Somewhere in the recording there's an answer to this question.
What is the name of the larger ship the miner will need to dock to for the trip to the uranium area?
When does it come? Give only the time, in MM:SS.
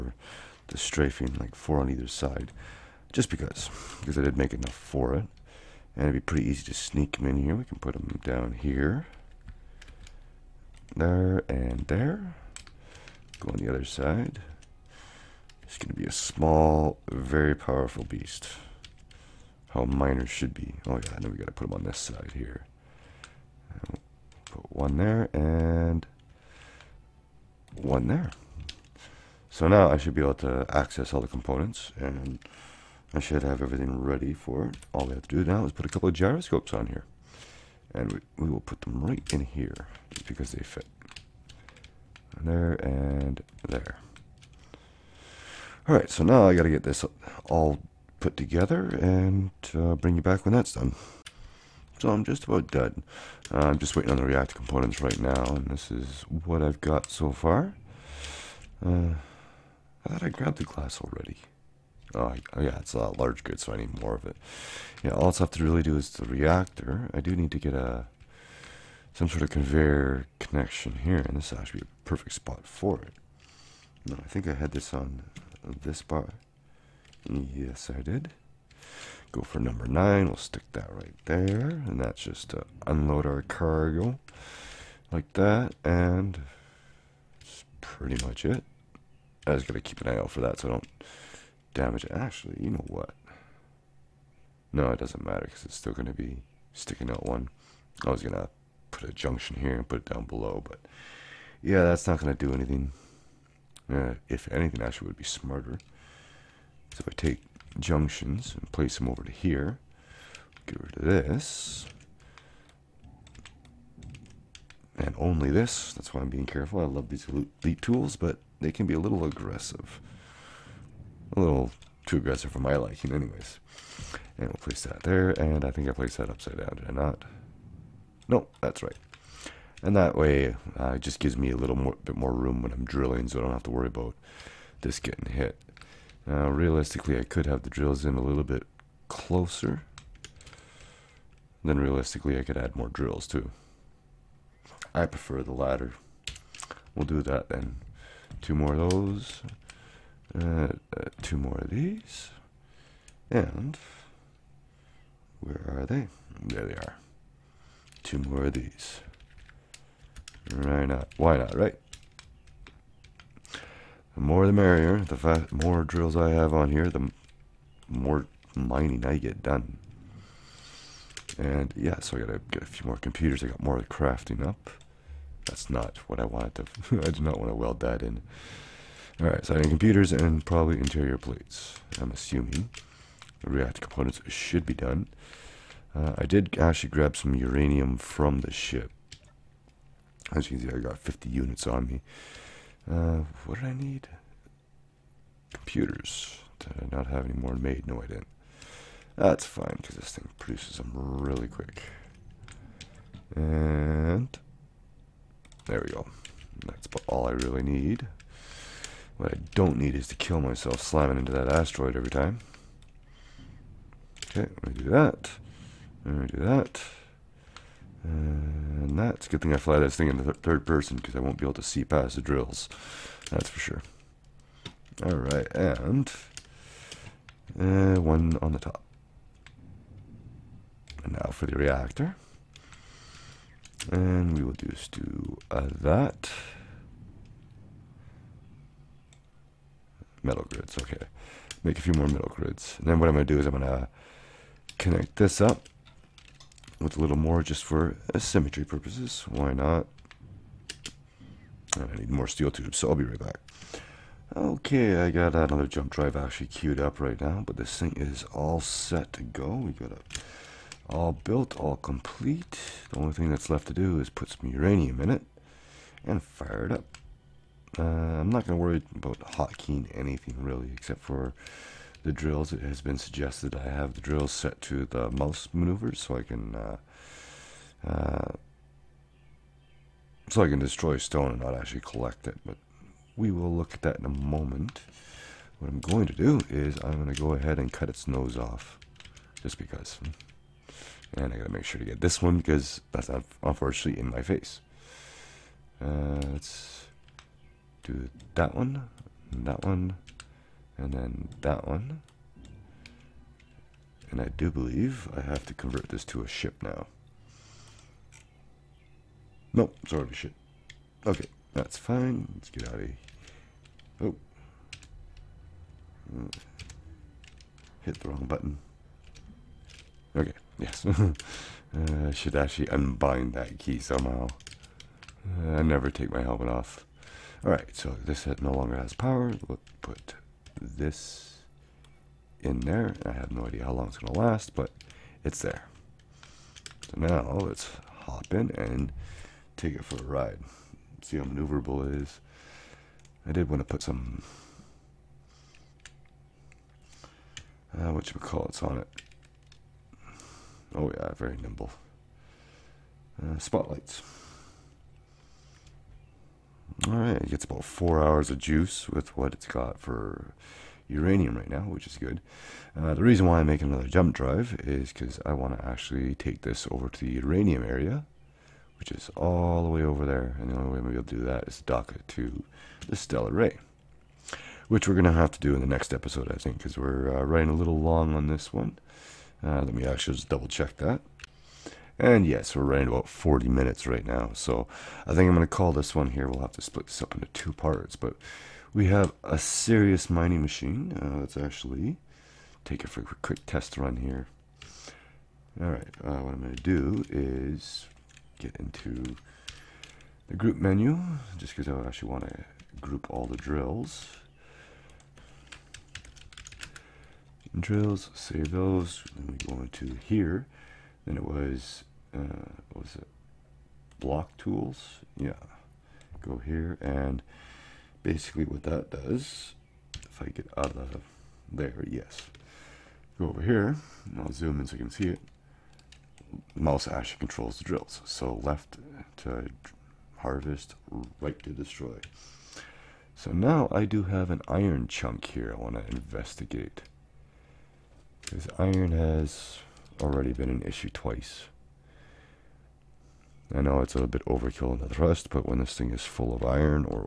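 06:12.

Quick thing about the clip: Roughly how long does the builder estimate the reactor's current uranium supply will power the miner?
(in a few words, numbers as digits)
About four hours.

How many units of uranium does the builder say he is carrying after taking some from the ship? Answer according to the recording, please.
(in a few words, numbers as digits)
50.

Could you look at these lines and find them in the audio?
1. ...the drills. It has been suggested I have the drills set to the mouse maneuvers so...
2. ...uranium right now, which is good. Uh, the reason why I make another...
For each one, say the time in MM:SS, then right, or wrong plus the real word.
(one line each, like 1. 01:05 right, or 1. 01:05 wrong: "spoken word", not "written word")
1. 04:32 right
2. 06:00 right.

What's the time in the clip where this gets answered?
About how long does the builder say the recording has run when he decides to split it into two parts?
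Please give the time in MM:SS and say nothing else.
06:23.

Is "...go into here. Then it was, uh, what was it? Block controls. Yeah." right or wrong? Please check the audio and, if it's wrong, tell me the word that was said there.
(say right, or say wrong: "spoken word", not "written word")
wrong: "tools", not "controls".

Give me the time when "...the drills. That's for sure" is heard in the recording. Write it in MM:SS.
03:42.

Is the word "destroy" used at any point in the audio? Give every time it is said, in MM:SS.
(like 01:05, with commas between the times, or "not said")
04:40, 07:11.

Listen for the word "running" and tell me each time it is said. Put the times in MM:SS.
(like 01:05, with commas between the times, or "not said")
06:17, 06:22.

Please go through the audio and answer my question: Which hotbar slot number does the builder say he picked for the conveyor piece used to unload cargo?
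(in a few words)
9.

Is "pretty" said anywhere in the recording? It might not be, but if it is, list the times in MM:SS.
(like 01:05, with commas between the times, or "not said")
00:06, 01:27.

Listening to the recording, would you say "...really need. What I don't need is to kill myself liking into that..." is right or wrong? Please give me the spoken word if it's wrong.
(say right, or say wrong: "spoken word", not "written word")
wrong: "slamming", not "liking".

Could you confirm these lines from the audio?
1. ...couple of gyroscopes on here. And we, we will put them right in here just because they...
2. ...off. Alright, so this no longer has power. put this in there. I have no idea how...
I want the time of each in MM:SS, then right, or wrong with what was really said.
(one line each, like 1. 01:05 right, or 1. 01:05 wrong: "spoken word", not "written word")
1. 00:35 right
2. 05:26 right.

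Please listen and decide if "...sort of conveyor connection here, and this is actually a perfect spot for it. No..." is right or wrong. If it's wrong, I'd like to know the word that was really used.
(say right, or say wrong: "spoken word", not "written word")
right.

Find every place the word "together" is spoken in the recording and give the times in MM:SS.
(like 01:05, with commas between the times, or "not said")
00:48.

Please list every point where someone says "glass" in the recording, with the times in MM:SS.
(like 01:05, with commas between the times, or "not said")
01:00.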